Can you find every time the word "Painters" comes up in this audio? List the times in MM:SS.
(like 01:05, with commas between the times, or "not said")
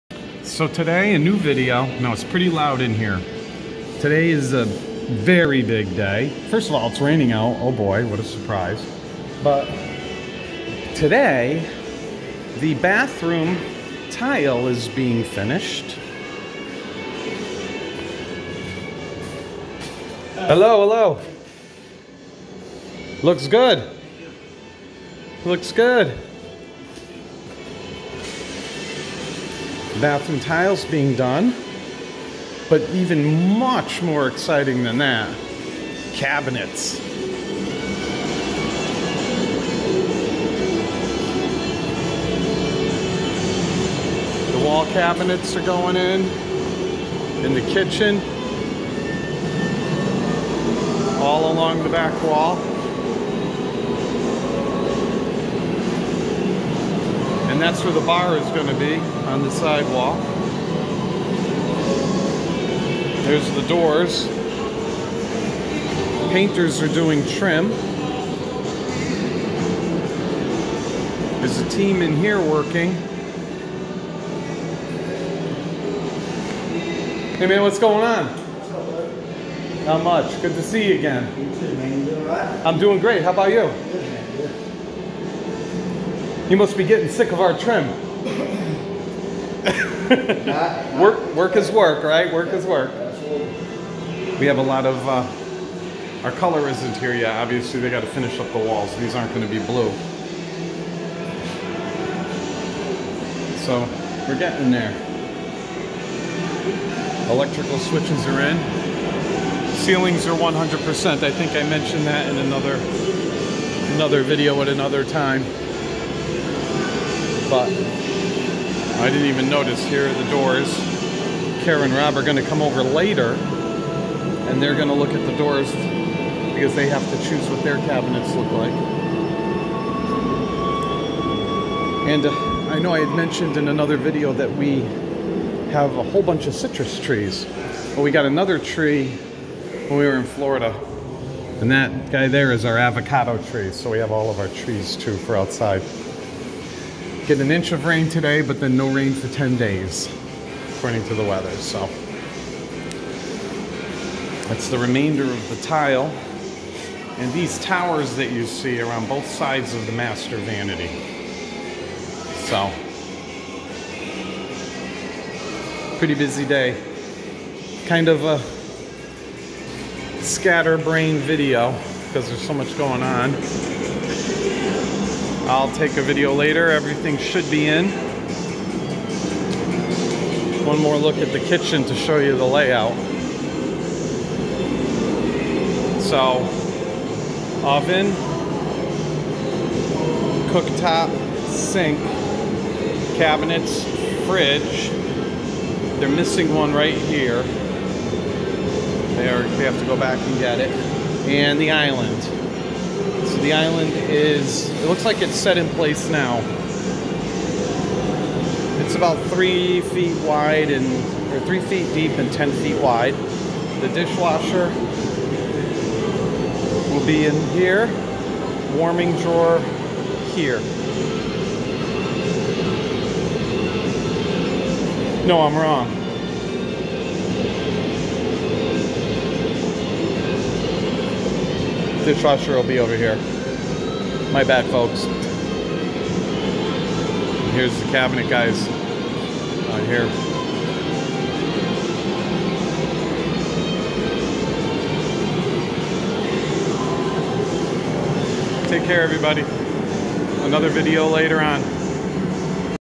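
01:06.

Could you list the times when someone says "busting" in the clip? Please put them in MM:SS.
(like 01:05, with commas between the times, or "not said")
not said.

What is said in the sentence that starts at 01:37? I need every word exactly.
Obviously, they got to finish up the walls.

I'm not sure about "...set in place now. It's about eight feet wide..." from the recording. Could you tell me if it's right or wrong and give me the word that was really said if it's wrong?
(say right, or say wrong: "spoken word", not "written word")
wrong: "three", not "eight".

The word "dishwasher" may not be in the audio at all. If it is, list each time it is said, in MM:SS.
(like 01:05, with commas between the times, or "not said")
03:33, 03:52.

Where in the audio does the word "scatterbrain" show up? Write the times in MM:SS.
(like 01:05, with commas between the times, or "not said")
02:50.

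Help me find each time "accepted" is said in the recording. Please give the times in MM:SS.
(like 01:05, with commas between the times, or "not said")
not said.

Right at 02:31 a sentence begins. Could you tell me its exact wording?
So that's the remainder of the tile.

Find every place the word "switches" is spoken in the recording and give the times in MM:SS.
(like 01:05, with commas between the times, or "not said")
01:47.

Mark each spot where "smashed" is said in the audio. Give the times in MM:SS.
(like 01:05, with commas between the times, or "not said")
not said.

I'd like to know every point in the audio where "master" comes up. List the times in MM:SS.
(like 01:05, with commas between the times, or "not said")
02:39.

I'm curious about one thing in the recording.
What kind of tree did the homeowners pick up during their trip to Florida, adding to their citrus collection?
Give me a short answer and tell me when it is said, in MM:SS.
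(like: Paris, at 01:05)
Avocado tree, at 02:22.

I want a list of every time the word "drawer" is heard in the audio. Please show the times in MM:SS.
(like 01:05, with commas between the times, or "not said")
03:39.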